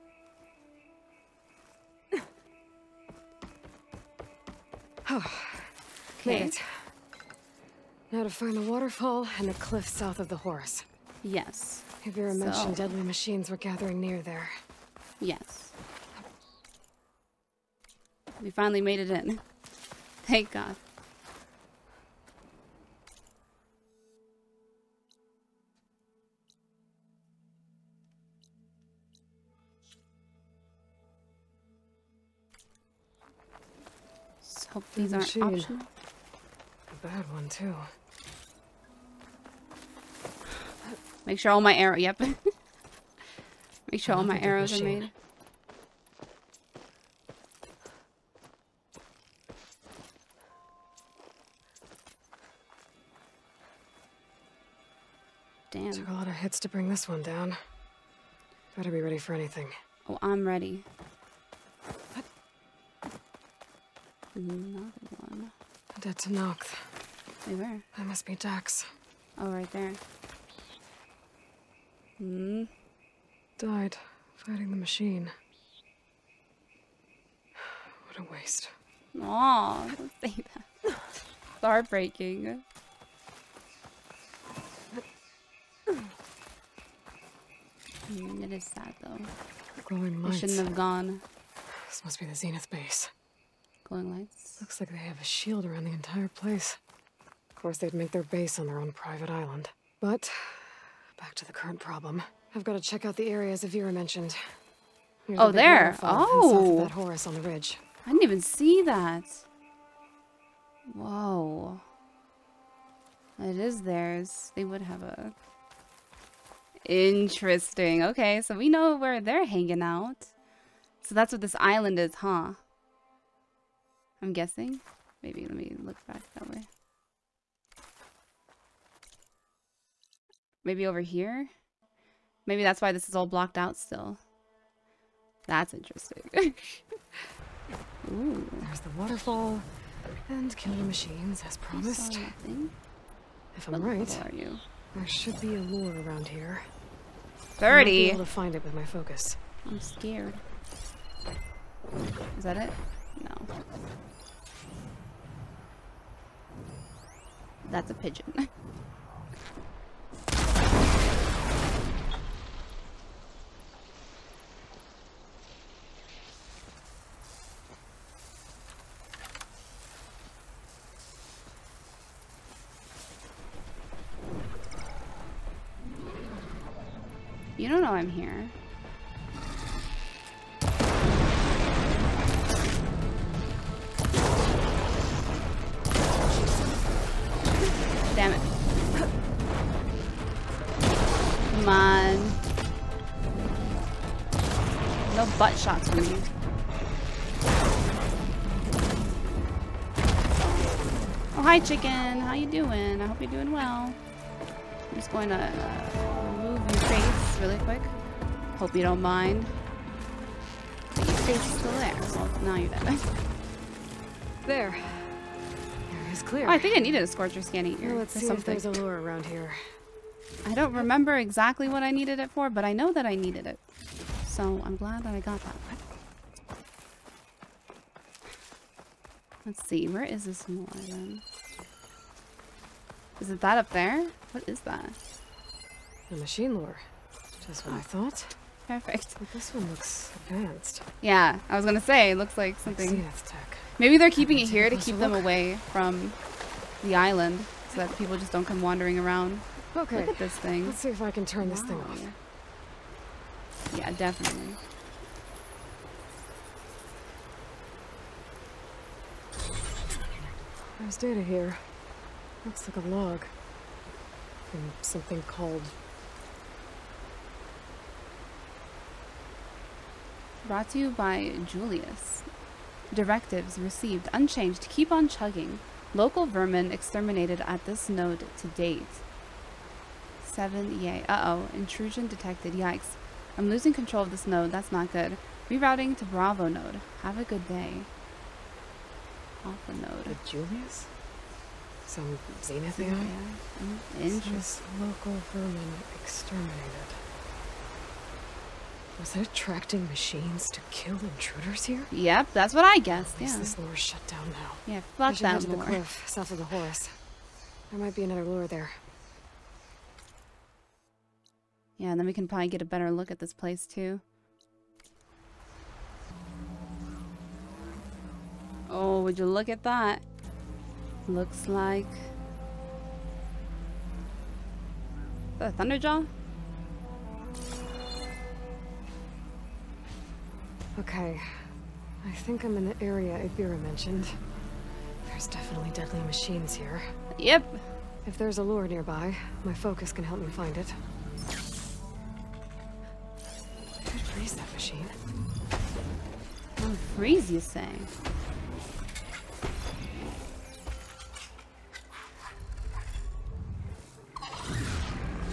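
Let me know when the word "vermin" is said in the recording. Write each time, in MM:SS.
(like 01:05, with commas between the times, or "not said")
04:36, 04:55.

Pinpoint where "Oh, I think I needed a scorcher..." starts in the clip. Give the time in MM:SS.
03:36.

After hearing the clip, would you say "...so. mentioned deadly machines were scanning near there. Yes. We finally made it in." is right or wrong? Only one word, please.
wrong.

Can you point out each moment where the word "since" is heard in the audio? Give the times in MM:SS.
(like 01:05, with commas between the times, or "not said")
not said.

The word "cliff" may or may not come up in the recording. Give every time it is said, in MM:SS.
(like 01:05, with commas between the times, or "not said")
00:09, 05:05.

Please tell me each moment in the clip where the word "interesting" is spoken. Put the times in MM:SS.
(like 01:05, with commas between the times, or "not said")
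01:56, 02:15, 04:54.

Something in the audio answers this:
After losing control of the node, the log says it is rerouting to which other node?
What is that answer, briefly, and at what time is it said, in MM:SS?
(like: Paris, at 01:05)
Bravo node, at 04:46.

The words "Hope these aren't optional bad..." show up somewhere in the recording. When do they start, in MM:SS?
00:34.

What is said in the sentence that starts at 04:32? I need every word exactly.
Directives received unchanged keep on chugging.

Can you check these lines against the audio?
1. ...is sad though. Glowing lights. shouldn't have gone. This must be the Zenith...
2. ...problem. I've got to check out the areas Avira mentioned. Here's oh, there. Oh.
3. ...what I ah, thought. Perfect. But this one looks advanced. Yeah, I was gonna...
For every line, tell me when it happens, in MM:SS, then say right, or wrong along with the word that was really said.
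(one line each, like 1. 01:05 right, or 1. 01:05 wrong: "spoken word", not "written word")
1. 01:28 right
2. 01:41 right
3. 03:57 right.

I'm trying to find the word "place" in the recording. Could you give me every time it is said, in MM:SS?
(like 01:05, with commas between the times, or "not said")
01:36, 05:13.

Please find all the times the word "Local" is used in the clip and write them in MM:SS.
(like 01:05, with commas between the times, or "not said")
04:35, 04:54.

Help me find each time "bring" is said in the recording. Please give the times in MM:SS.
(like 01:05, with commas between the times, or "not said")
00:56.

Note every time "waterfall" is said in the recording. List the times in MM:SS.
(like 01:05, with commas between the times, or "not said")
00:08, 02:18.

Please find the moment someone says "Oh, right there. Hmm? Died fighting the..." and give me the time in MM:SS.
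01:09.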